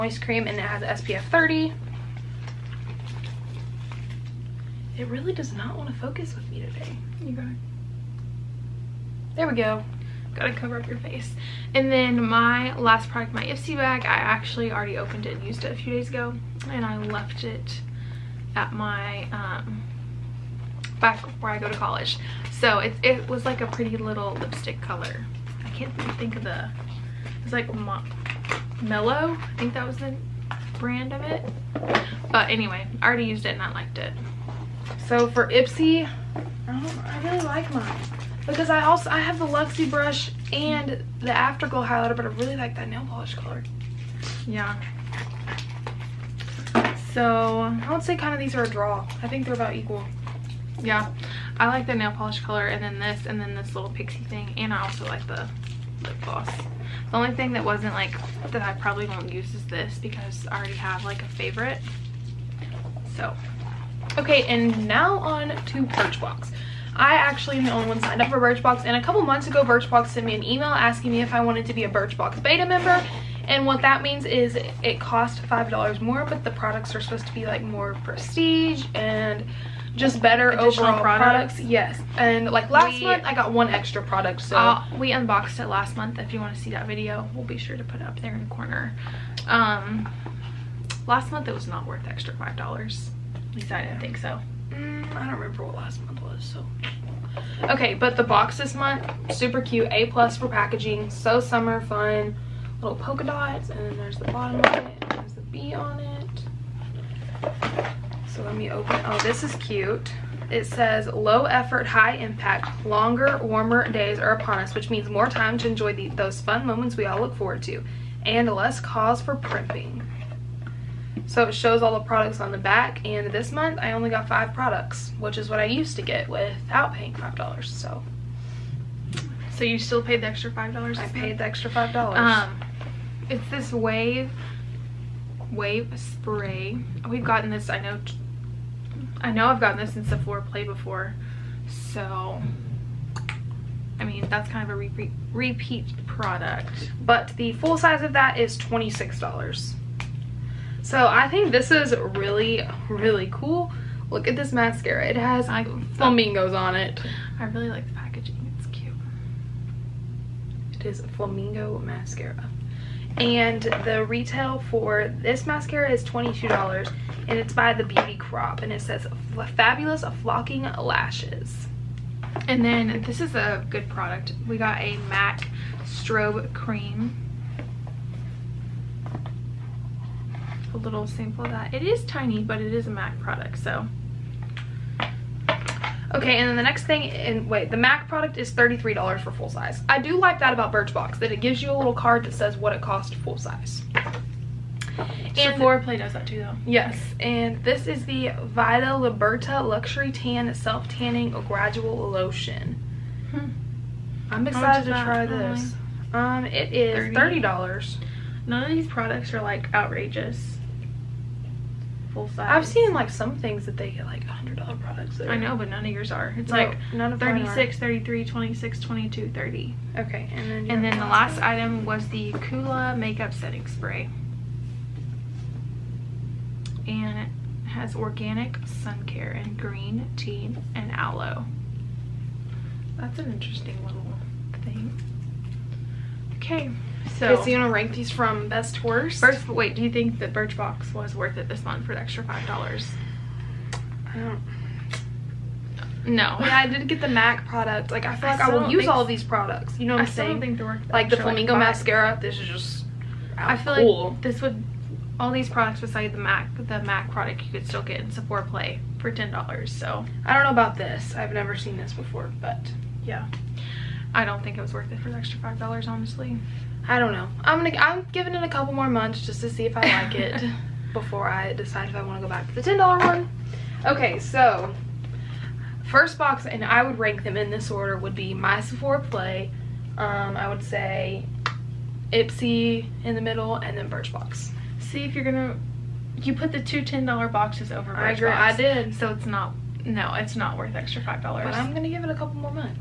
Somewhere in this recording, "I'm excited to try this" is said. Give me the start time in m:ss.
3:24.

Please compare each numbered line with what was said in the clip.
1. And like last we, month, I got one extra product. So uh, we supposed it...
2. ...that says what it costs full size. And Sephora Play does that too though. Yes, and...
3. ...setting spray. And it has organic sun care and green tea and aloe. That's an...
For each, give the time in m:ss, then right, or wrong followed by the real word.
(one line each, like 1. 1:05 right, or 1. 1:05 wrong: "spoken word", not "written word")
1. 1:22 wrong: "unboxed", not "supposed"
2. 3:12 right
3. 3:43 right.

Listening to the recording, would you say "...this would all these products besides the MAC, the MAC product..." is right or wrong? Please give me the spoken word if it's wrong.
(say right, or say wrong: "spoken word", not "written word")
right.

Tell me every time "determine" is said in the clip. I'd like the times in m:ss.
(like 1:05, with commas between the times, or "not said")
not said.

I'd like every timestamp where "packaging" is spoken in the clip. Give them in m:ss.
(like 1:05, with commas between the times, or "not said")
1:40, 2:37.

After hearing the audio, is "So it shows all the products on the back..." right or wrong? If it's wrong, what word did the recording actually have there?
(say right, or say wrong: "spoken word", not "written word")
right.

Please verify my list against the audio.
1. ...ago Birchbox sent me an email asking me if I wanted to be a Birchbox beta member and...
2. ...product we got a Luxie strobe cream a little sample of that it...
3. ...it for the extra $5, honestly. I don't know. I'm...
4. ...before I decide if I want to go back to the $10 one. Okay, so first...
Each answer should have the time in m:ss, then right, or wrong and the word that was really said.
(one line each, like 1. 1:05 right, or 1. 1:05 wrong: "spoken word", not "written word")
1. 1:09 right
2. 2:53 wrong: "Mac", not "Luxie"
3. 4:24 right
4. 4:30 right.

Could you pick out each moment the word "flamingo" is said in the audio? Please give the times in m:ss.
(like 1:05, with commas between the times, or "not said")
2:35, 2:41, 4:11.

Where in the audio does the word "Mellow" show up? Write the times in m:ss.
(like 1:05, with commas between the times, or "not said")
0:28.